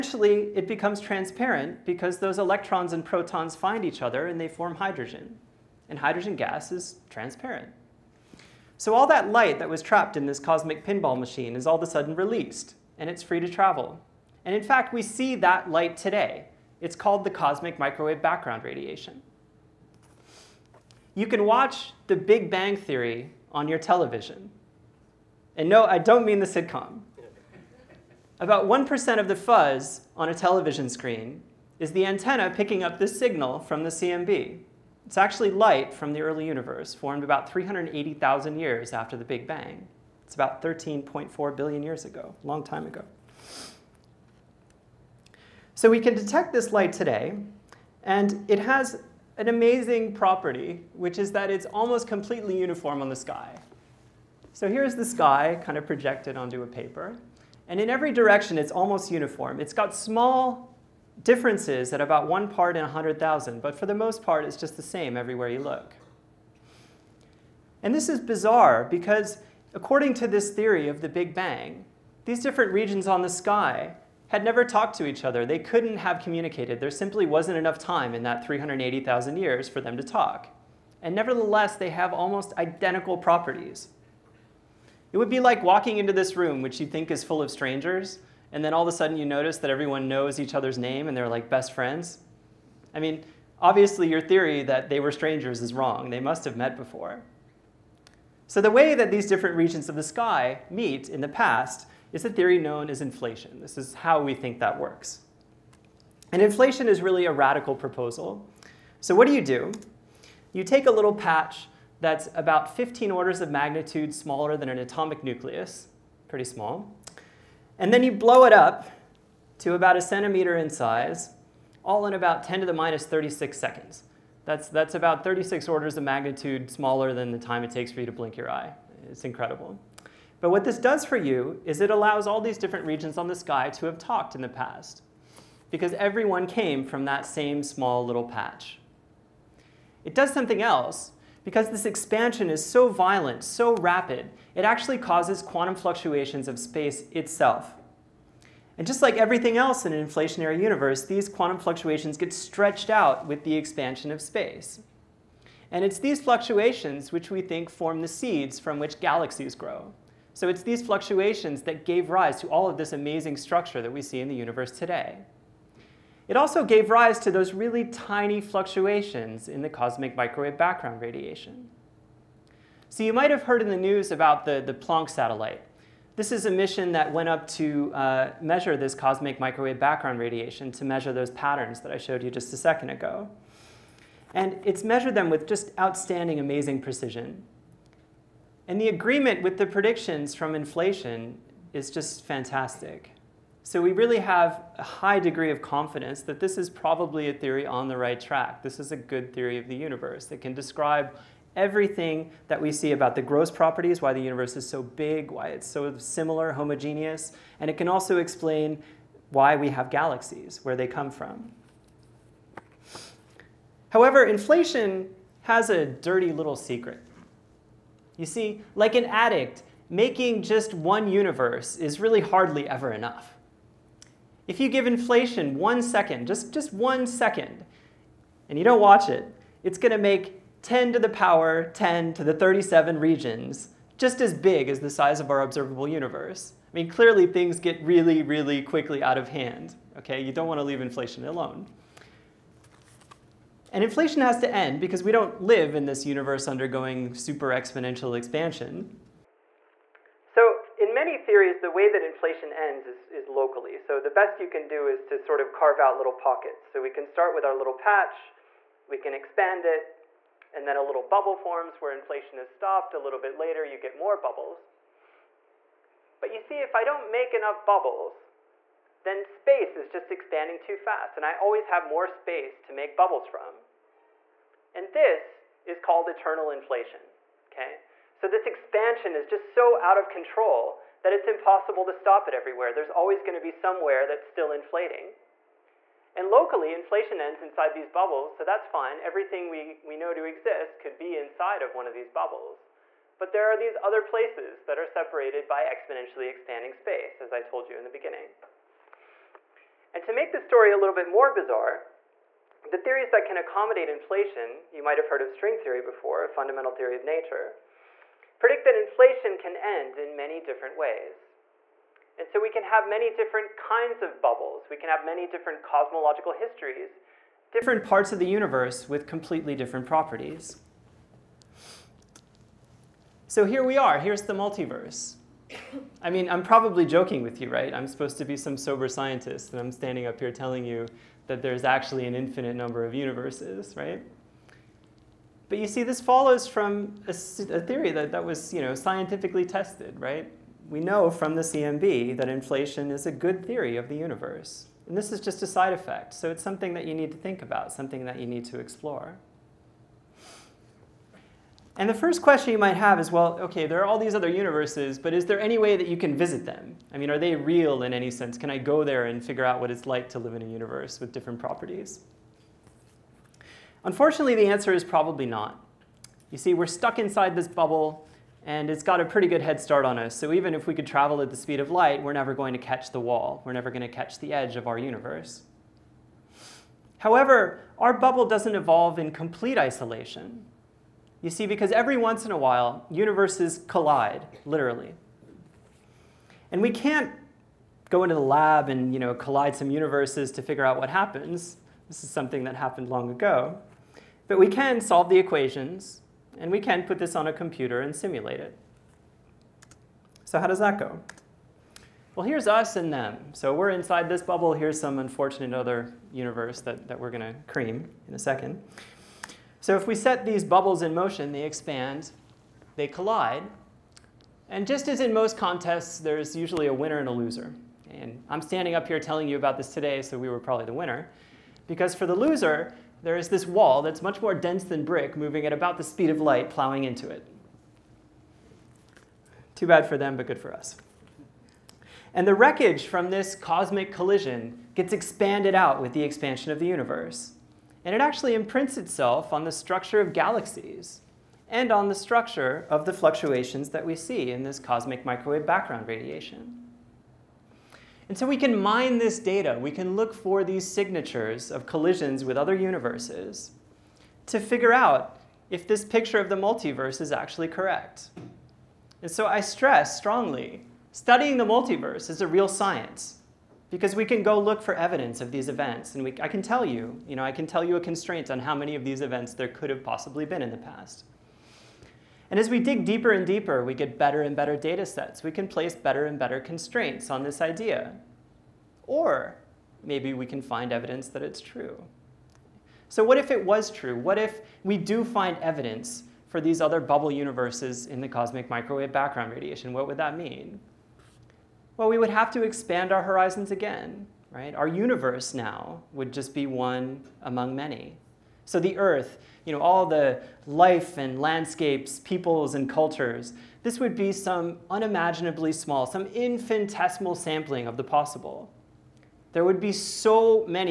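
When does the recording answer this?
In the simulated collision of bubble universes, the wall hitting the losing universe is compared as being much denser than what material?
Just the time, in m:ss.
7:04.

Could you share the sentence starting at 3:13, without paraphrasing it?
So we really have a high degree of confidence that this is probably a theory on the right track.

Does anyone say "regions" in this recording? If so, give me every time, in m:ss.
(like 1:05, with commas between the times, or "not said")
1:12, 1:39, 2:12, 3:52.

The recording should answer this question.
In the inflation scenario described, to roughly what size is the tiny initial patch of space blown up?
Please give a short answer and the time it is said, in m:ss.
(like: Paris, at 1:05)
a centimeter, at 1:59.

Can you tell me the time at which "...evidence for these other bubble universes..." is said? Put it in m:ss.
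8:05.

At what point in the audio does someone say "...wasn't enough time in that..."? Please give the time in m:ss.
1:17.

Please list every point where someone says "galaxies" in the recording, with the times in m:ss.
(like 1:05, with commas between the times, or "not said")
2:38, 3:29, 7:20.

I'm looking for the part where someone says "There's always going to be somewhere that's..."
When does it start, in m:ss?
4:42.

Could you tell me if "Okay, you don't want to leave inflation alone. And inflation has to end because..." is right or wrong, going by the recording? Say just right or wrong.
right.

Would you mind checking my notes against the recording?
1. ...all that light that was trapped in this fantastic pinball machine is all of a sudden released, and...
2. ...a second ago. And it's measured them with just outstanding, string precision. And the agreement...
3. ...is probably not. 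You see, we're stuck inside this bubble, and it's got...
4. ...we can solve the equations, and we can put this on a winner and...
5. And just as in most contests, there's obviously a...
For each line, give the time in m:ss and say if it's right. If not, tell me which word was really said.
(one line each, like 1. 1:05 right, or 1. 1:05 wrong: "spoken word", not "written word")
1. 0:08 wrong: "cosmic", not "fantastic"
2. 3:02 wrong: "amazing", not "string"
3. 6:04 right
4. 6:34 wrong: "computer", not "winner"
5. 6:54 wrong: "usually", not "obviously".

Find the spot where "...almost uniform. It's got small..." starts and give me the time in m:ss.
0:58.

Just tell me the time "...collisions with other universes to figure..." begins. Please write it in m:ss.
7:31.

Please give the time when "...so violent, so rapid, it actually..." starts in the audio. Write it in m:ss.
2:22.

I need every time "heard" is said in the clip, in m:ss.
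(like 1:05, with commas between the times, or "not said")
2:53, 5:05.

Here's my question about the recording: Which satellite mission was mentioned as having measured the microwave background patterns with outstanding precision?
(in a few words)
Planck.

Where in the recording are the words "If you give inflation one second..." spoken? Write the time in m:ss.
3:44.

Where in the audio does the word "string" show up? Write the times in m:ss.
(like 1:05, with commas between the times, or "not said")
5:05.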